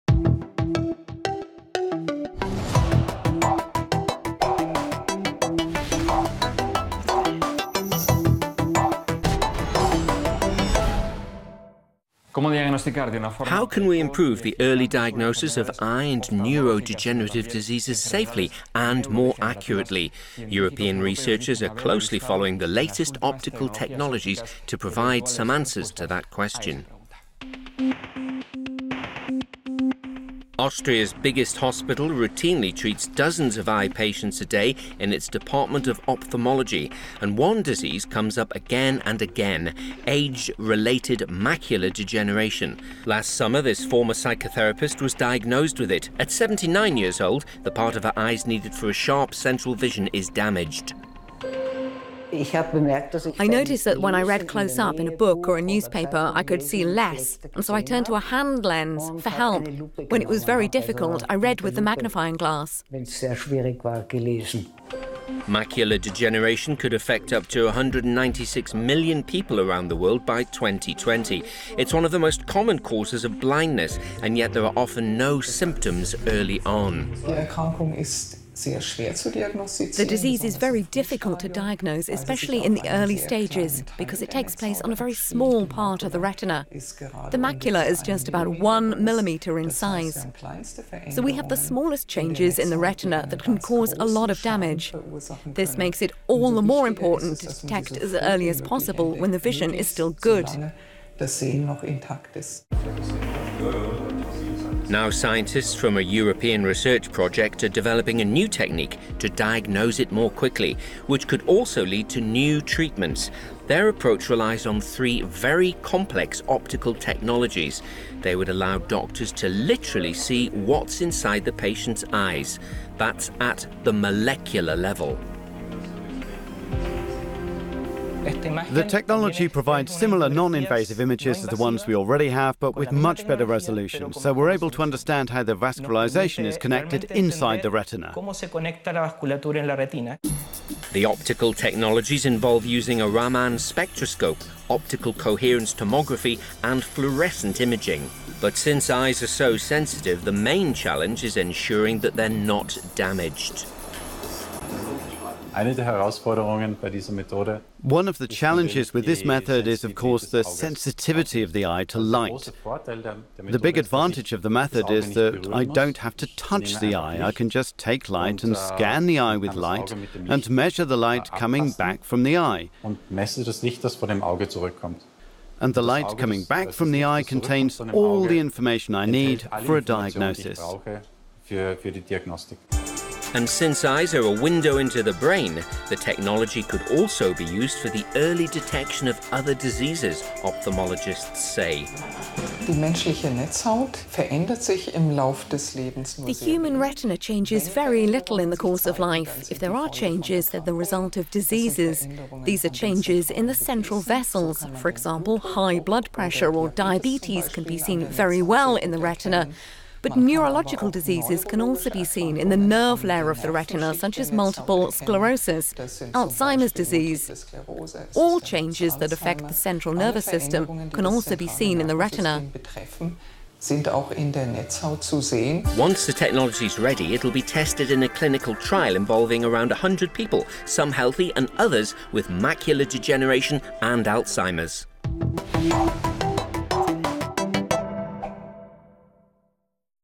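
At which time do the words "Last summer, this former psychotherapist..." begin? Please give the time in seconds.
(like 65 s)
43 s.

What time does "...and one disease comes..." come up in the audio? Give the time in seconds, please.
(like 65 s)
37 s.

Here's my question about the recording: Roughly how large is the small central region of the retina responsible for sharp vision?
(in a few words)
one millimeter.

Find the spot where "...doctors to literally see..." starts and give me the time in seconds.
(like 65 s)
118 s.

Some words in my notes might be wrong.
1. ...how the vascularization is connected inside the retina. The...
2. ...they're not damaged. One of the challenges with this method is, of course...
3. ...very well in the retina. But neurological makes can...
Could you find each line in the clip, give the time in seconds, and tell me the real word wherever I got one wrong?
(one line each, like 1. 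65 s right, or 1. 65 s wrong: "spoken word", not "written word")
1. 135 s right
2. 152 s right
3. 208 s wrong: "diseases", not "makes".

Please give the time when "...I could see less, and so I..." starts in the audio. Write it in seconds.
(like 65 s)
56 s.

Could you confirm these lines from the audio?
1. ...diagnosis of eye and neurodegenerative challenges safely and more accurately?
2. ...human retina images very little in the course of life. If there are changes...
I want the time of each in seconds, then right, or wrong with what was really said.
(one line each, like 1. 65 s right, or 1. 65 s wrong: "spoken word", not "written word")
1. 14 s wrong: "diseases", not "challenges"
2. 196 s wrong: "changes", not "images".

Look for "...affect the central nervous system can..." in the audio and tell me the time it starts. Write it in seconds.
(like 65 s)
219 s.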